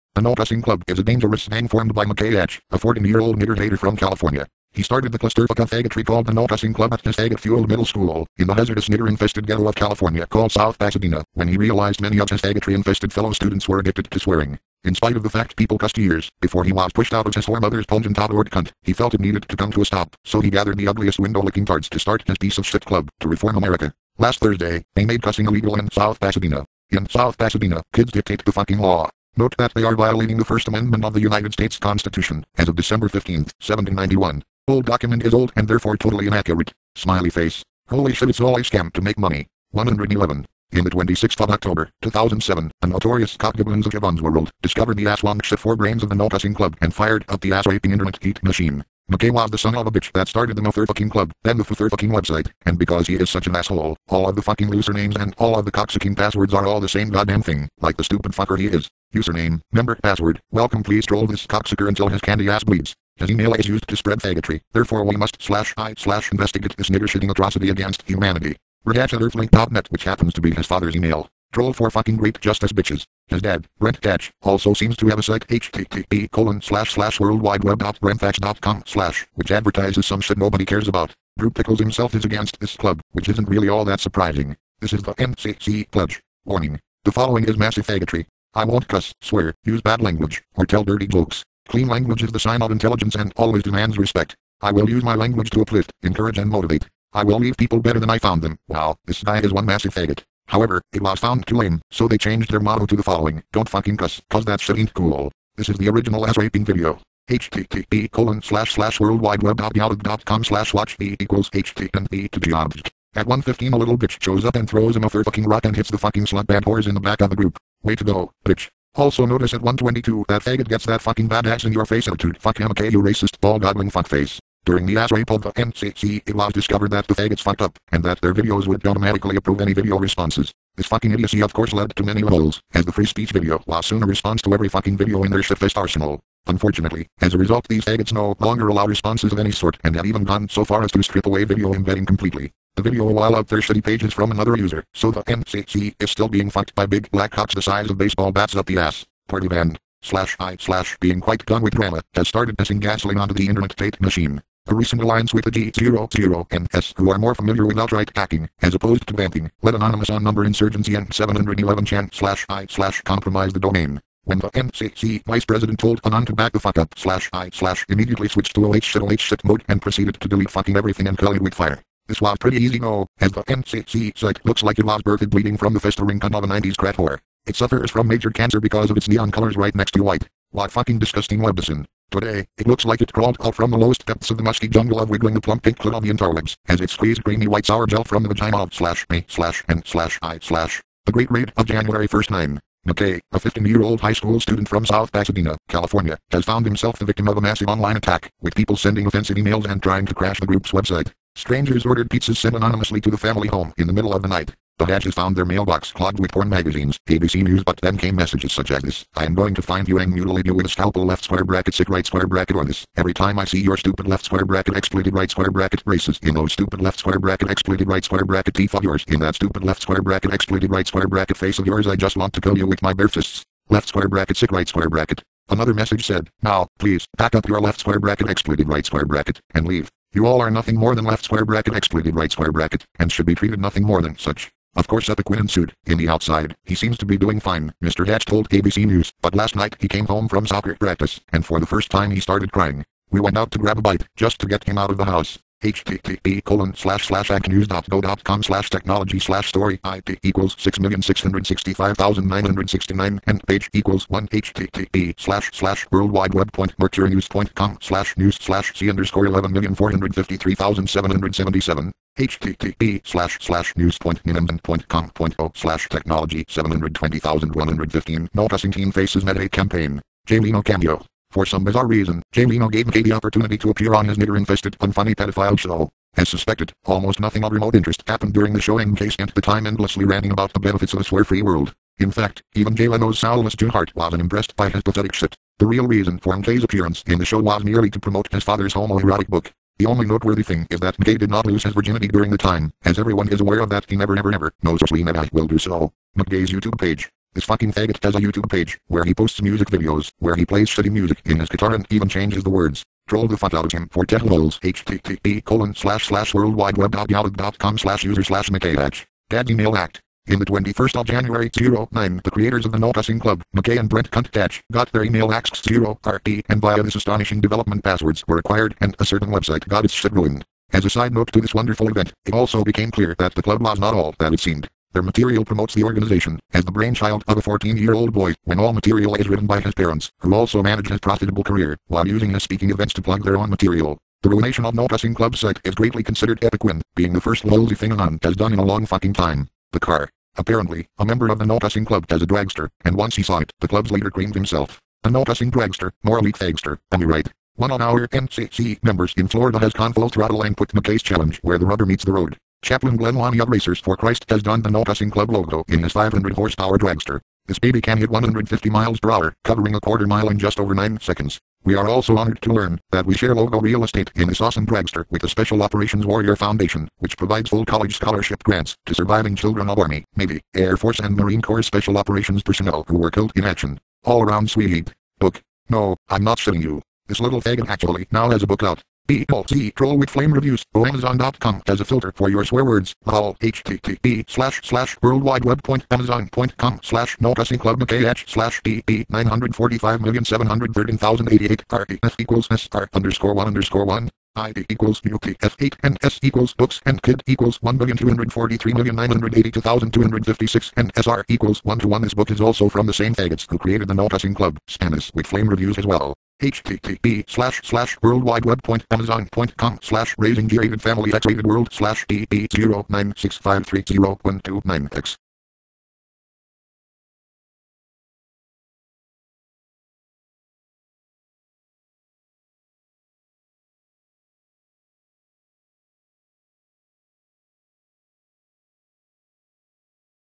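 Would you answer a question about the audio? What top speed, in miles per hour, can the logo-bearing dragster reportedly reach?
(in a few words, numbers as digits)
150.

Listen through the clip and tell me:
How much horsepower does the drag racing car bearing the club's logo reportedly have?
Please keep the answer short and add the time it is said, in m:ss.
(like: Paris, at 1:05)
500, at 5:55.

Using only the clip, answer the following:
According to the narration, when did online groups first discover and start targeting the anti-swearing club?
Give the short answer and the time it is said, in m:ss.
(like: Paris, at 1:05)
October 26, 2007, at 0:40.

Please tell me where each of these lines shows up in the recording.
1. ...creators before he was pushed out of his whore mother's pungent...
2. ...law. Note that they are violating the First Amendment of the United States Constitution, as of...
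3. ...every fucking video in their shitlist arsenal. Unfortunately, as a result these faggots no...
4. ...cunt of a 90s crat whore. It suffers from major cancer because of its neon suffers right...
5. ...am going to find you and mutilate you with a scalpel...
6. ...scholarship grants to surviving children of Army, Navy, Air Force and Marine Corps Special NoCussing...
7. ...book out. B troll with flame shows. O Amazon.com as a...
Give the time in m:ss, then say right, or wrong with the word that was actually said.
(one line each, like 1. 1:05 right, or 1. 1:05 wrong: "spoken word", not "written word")
1. 0:15 wrong: "years", not "creators"
2. 0:28 right
3. 2:14 right
4. 2:56 wrong: "colors", not "suffers"
5. 3:29 right
6. 6:07 wrong: "Operations", not "NoCussing"
7. 6:18 wrong: "reviews", not "shows".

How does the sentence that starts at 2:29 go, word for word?
Partyvan, slash I, slash being quite done with drama, has started pissing gasoline onto the internet hate machine.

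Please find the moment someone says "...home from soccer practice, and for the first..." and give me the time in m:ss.
4:00.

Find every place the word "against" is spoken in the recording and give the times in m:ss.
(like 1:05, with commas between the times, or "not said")
1:07, 1:22.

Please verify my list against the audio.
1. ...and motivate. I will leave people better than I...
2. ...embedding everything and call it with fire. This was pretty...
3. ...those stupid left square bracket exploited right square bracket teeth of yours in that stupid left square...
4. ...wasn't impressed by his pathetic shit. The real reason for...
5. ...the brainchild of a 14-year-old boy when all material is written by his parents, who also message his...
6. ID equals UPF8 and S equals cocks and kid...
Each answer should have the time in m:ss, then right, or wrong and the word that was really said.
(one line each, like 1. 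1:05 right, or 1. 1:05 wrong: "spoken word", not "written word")
1. 1:36 right
2. 2:50 wrong: "fucking", not "embedding"
3. 3:36 right
4. 4:43 right
5. 5:26 wrong: "manage", not "message"
6. 6:34 wrong: "books", not "cocks".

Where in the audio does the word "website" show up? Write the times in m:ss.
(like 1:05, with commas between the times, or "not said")
0:52, 3:20, 5:19.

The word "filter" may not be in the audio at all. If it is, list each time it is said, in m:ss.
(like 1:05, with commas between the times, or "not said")
6:21.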